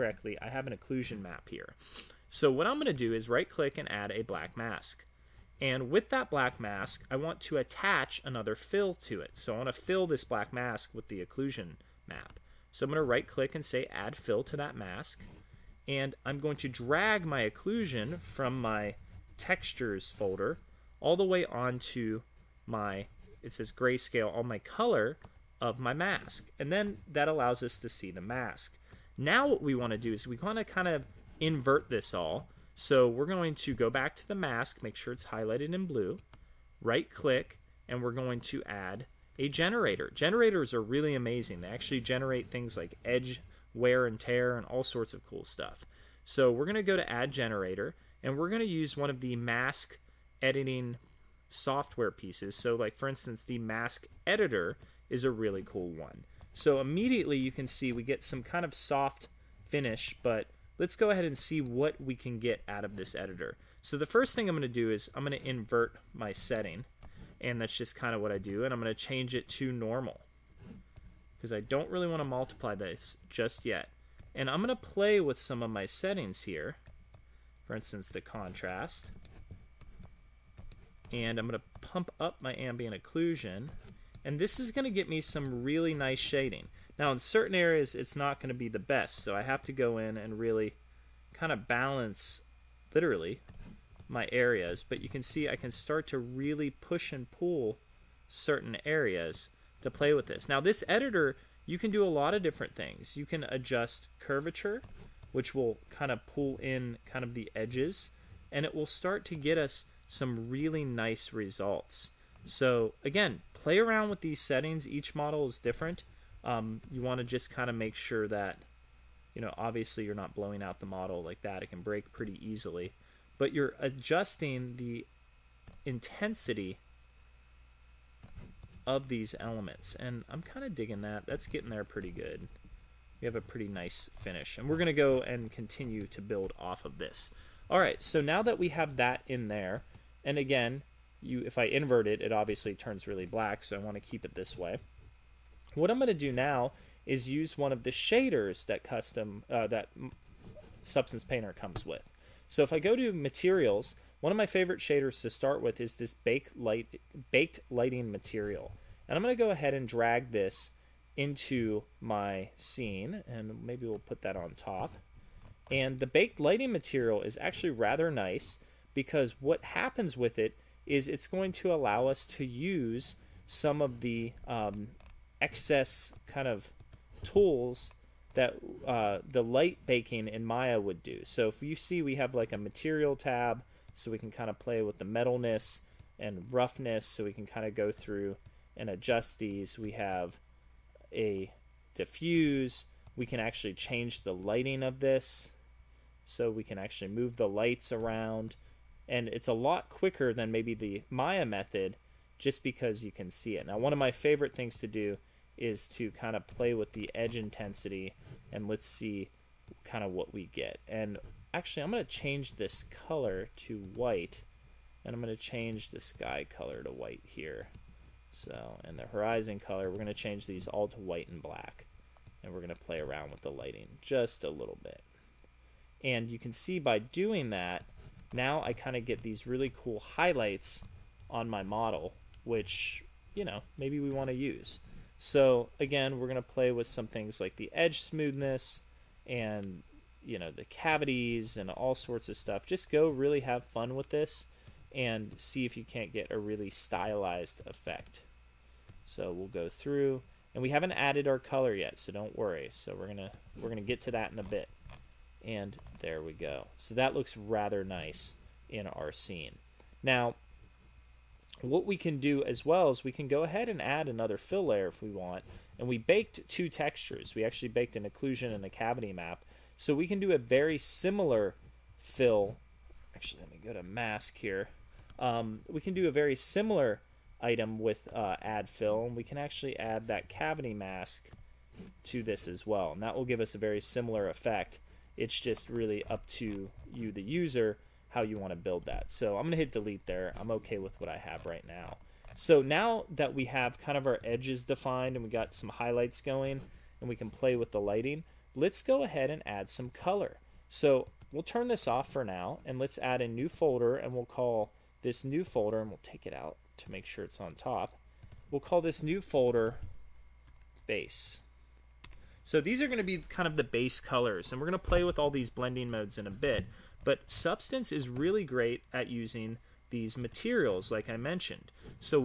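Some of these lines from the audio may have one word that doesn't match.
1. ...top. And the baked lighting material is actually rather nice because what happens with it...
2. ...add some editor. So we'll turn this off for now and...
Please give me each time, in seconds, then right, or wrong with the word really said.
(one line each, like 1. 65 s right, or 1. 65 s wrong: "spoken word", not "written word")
1. 164 s right
2. 299 s wrong: "color", not "editor".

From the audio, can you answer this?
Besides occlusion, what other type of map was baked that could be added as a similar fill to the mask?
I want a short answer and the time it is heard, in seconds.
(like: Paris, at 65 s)
cavity map, at 268 s.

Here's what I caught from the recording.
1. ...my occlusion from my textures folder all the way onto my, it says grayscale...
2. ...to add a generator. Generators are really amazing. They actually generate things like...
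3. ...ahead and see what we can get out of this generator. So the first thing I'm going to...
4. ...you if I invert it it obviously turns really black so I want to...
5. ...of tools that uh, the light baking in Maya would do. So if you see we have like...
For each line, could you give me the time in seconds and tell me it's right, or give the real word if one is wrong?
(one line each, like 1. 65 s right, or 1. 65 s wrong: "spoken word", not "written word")
1. 17 s right
2. 38 s right
3. 61 s wrong: "editor", not "generator"
4. 141 s right
5. 176 s right.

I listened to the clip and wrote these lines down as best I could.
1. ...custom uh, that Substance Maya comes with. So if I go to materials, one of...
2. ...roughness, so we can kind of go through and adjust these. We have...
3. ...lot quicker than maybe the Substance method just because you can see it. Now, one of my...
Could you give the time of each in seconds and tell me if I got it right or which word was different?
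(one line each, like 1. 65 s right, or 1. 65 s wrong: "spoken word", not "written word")
1. 148 s wrong: "Painter", not "Maya"
2. 186 s right
3. 199 s wrong: "Maya", not "Substance".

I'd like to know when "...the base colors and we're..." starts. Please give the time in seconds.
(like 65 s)
313 s.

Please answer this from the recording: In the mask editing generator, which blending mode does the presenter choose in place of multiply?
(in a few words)
normal.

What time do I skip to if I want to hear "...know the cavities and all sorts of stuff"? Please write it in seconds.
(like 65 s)
240 s.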